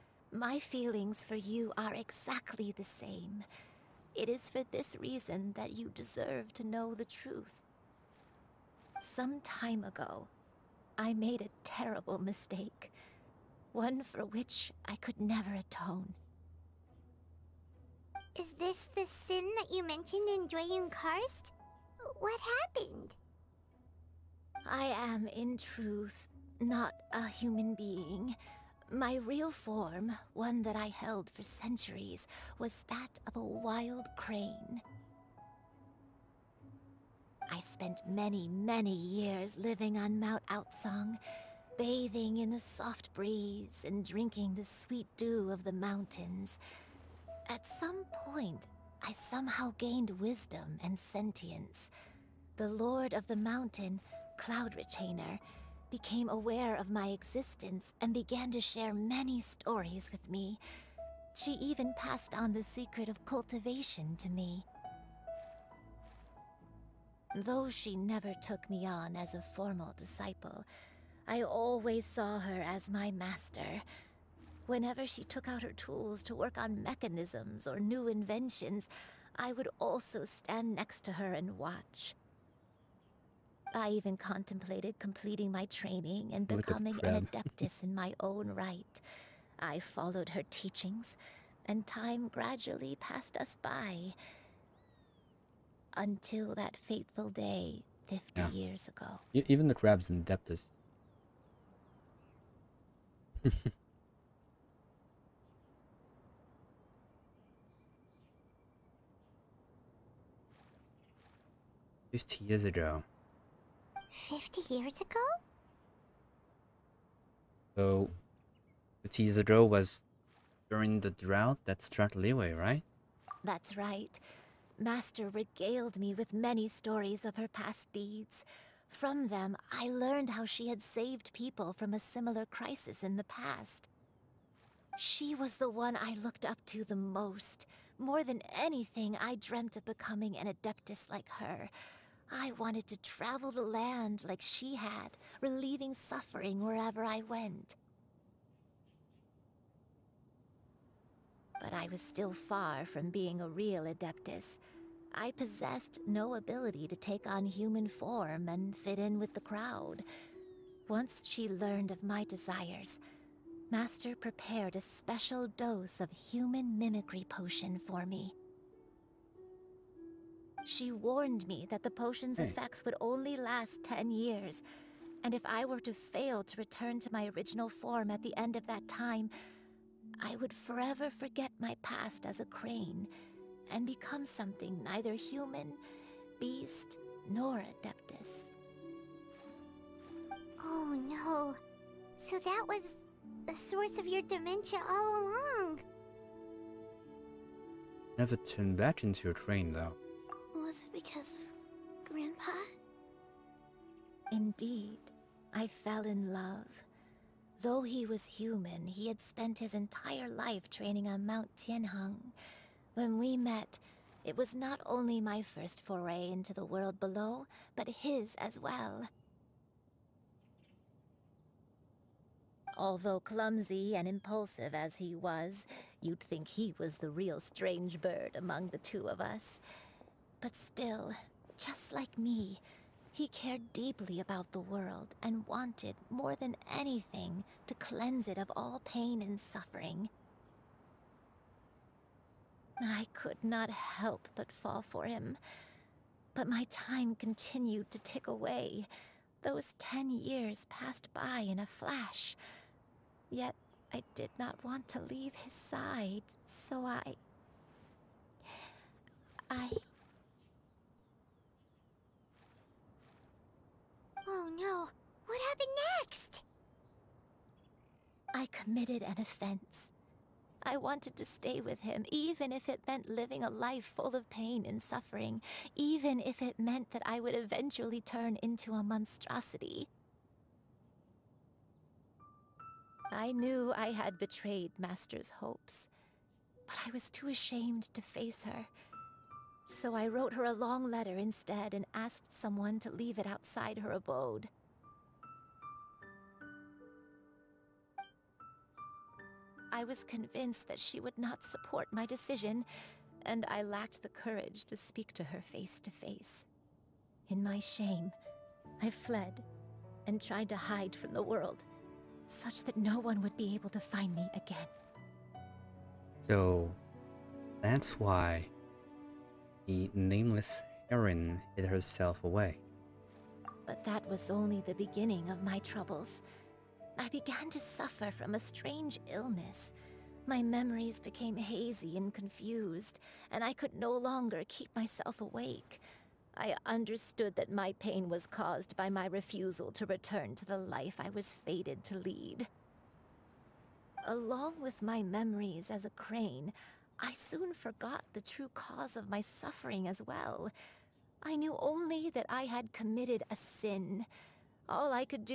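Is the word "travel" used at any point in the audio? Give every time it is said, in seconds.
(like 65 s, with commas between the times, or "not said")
143 s.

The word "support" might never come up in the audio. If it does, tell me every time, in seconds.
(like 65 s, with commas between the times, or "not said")
301 s.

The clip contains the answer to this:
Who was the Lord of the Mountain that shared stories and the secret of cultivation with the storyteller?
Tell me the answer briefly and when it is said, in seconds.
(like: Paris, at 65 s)
Cloud Retainer, at 54 s.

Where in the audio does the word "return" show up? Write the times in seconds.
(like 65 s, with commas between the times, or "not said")
176 s, 339 s.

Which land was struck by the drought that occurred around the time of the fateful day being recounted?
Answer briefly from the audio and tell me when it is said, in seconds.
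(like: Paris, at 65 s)
Liyue, at 122 s.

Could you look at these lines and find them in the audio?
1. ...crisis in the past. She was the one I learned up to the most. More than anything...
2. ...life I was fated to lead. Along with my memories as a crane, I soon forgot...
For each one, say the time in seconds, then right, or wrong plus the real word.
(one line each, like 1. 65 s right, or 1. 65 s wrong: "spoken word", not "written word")
1. 132 s wrong: "looked", not "learned"
2. 340 s right.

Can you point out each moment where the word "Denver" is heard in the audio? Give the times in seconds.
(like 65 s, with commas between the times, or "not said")
not said.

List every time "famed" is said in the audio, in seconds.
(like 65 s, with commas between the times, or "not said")
not said.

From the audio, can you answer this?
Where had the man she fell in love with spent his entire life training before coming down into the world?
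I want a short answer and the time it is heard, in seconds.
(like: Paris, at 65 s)
Mount Tianheng, at 211 s.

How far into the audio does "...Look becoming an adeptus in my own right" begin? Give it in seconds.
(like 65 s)
86 s.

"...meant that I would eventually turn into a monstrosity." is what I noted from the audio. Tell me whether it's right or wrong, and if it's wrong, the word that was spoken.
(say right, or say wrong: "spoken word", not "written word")
right.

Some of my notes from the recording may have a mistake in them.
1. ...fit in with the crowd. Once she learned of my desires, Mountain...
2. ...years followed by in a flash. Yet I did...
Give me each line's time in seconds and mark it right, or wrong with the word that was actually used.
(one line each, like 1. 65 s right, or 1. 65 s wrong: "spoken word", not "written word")
1. 158 s wrong: "Master", not "Mountain"
2. 250 s wrong: "passed", not "followed".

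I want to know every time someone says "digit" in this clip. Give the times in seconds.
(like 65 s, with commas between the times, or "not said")
not said.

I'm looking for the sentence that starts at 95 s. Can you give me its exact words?
Until that fateful day, 50 yeah.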